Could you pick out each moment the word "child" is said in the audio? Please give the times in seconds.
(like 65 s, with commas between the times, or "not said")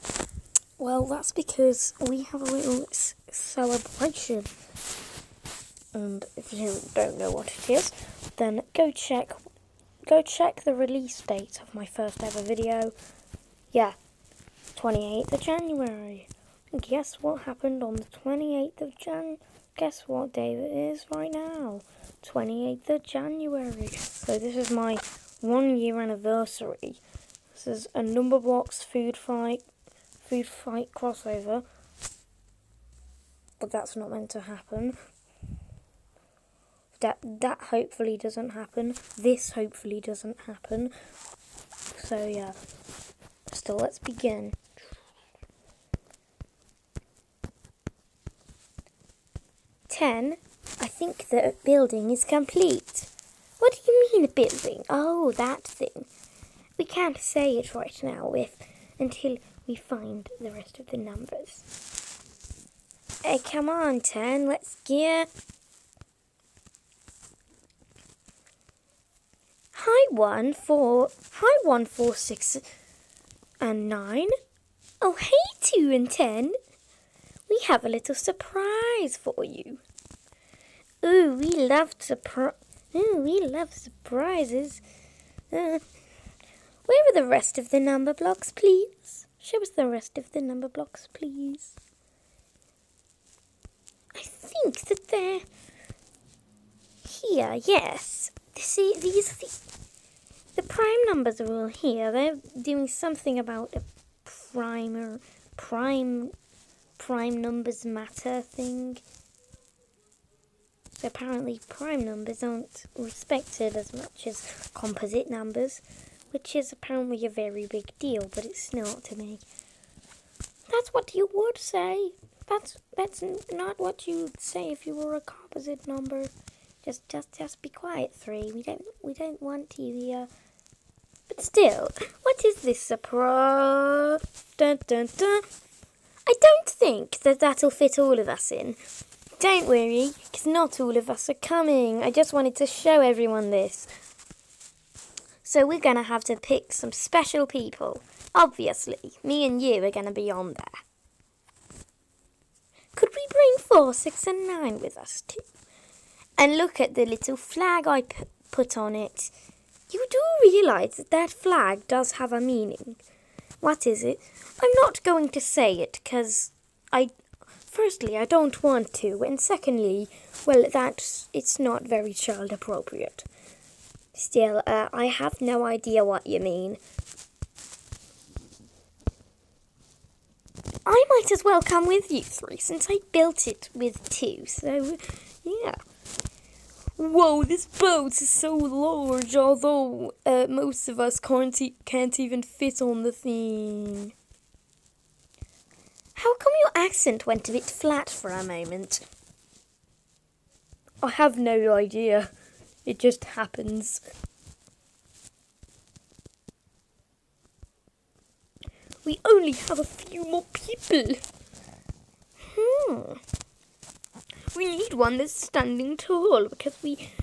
172 s.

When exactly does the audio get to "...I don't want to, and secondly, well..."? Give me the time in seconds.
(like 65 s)
168 s.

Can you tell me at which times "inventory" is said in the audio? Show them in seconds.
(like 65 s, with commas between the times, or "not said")
not said.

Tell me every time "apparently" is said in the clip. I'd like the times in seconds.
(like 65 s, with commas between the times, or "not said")
111 s, 116 s.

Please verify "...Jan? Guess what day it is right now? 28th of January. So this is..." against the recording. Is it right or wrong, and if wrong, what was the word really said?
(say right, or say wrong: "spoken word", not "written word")
right.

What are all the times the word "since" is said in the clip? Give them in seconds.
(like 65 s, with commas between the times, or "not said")
182 s.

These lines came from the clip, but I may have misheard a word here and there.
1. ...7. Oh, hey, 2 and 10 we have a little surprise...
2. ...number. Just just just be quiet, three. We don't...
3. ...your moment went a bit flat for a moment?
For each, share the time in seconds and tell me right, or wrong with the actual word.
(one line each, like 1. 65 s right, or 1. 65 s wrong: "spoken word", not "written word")
1. 73 s wrong: "9", not "7"
2. 125 s right
3. 196 s wrong: "accent", not "moment".